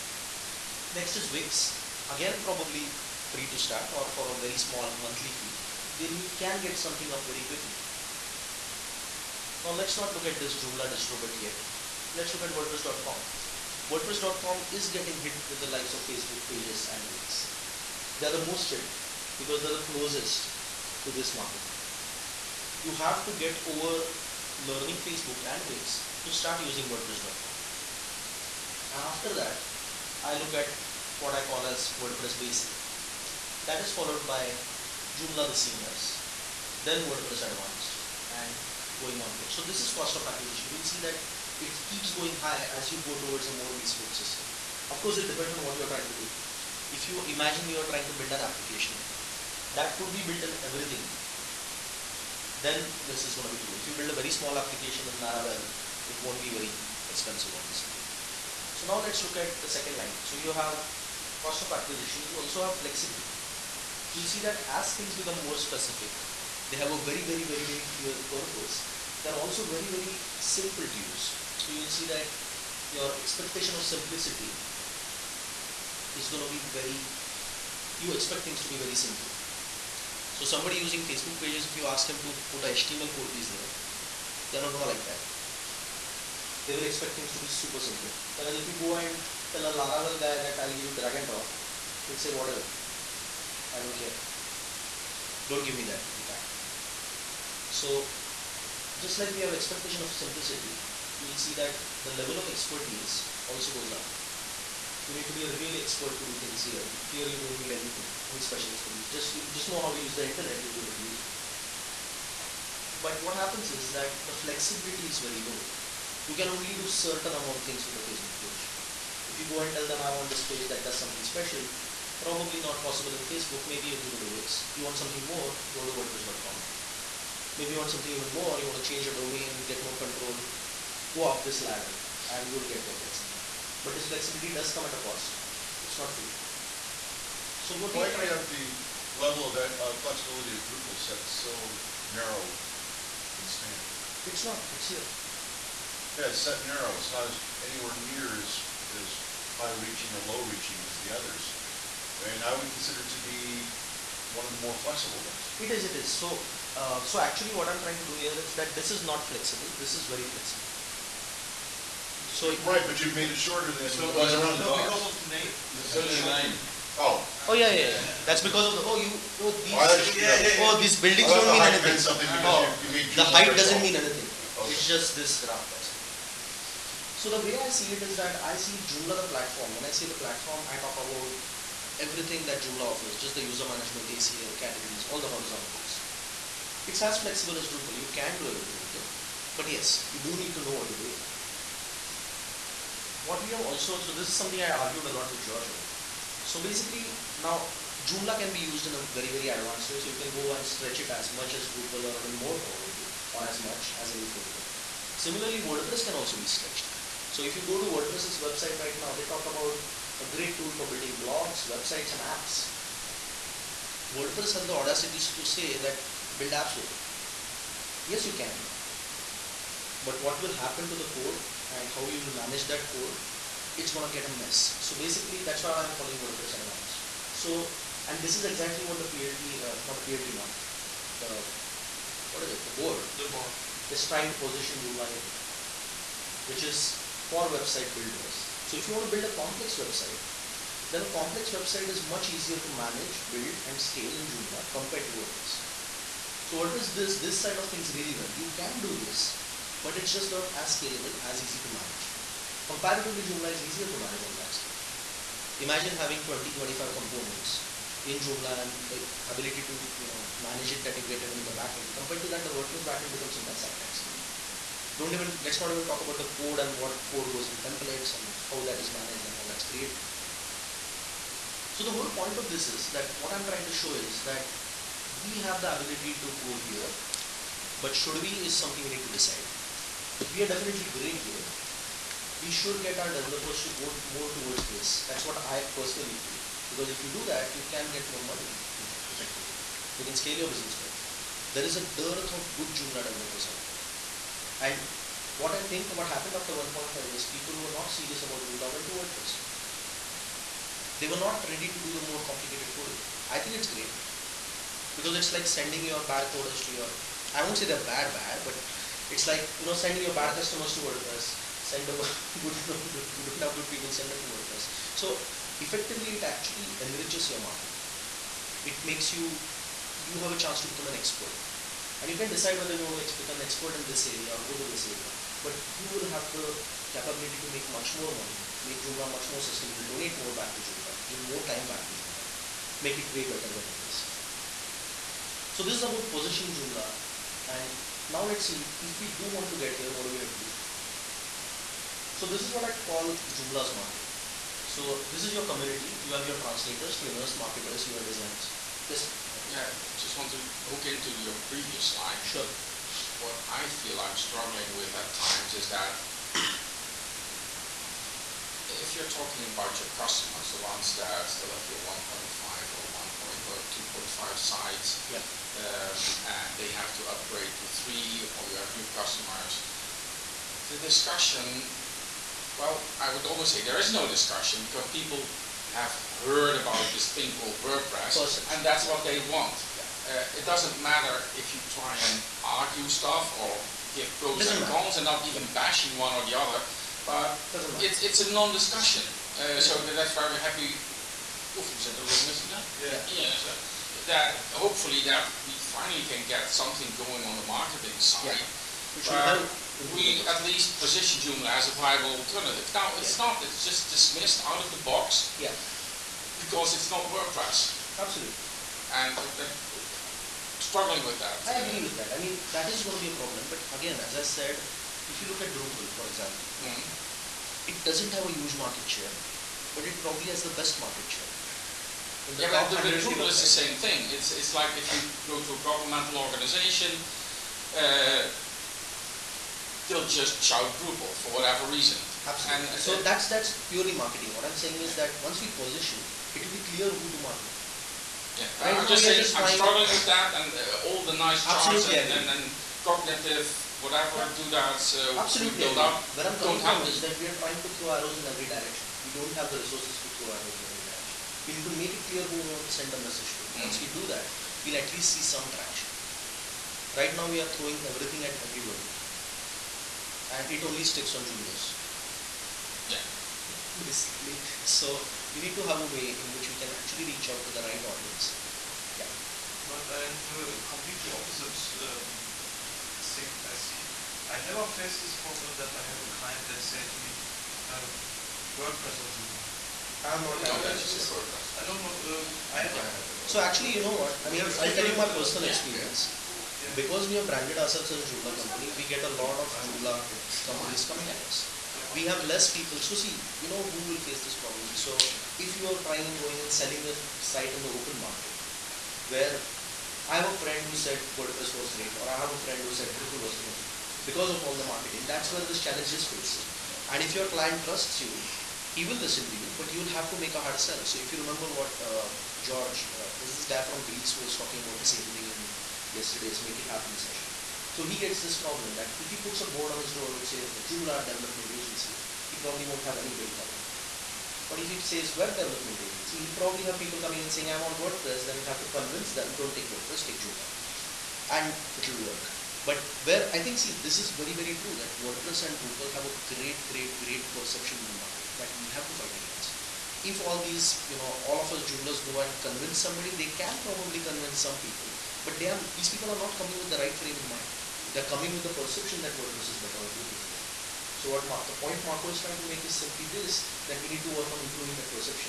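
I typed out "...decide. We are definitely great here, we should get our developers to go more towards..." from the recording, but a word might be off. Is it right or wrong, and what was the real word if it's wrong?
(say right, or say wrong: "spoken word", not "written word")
right.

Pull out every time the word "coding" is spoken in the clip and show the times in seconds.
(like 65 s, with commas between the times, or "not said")
302 s.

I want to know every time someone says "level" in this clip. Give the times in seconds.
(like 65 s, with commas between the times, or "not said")
102 s, 139 s.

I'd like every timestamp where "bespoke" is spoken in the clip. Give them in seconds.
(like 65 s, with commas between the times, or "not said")
43 s.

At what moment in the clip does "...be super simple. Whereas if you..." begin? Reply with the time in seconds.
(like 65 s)
87 s.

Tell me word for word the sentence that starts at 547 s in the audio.
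They're coming with the perception that WordPress is better or Drupal is better.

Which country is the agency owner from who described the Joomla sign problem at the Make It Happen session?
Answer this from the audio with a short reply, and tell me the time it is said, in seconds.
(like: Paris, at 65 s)
Greece, at 513 s.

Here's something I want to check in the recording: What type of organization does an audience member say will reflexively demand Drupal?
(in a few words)
governmental organization.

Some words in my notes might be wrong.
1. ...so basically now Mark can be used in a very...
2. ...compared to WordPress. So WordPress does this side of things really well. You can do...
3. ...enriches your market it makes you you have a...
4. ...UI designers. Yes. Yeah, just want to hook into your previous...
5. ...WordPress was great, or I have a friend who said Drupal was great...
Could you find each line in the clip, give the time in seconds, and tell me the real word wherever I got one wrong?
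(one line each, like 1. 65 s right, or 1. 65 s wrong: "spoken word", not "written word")
1. 196 s wrong: "Joomla", not "Mark"
2. 244 s right
3. 316 s right
4. 347 s right
5. 501 s right.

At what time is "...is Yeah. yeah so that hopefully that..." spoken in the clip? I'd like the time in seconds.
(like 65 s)
392 s.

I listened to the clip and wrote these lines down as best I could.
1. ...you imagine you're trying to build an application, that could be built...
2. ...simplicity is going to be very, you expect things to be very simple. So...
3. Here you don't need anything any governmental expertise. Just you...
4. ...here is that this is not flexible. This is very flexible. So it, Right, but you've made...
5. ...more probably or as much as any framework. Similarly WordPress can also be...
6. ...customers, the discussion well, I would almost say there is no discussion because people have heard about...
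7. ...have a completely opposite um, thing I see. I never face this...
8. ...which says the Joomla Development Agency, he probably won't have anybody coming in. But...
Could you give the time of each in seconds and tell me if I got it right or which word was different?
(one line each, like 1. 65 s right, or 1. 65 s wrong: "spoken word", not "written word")
1. 47 s right
2. 73 s right
3. 107 s wrong: "special", not "governmental"
4. 158 s right
5. 202 s right
6. 368 s right
7. 470 s right
8. 520 s right.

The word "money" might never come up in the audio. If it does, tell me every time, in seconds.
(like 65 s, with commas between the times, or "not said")
288 s, 328 s.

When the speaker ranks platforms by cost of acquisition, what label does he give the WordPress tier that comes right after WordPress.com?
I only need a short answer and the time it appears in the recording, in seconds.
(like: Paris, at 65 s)
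WordPress Basic, at 31 s.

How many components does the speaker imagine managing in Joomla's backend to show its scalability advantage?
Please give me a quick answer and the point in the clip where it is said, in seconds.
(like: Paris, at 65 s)
20, 25, at 256 s.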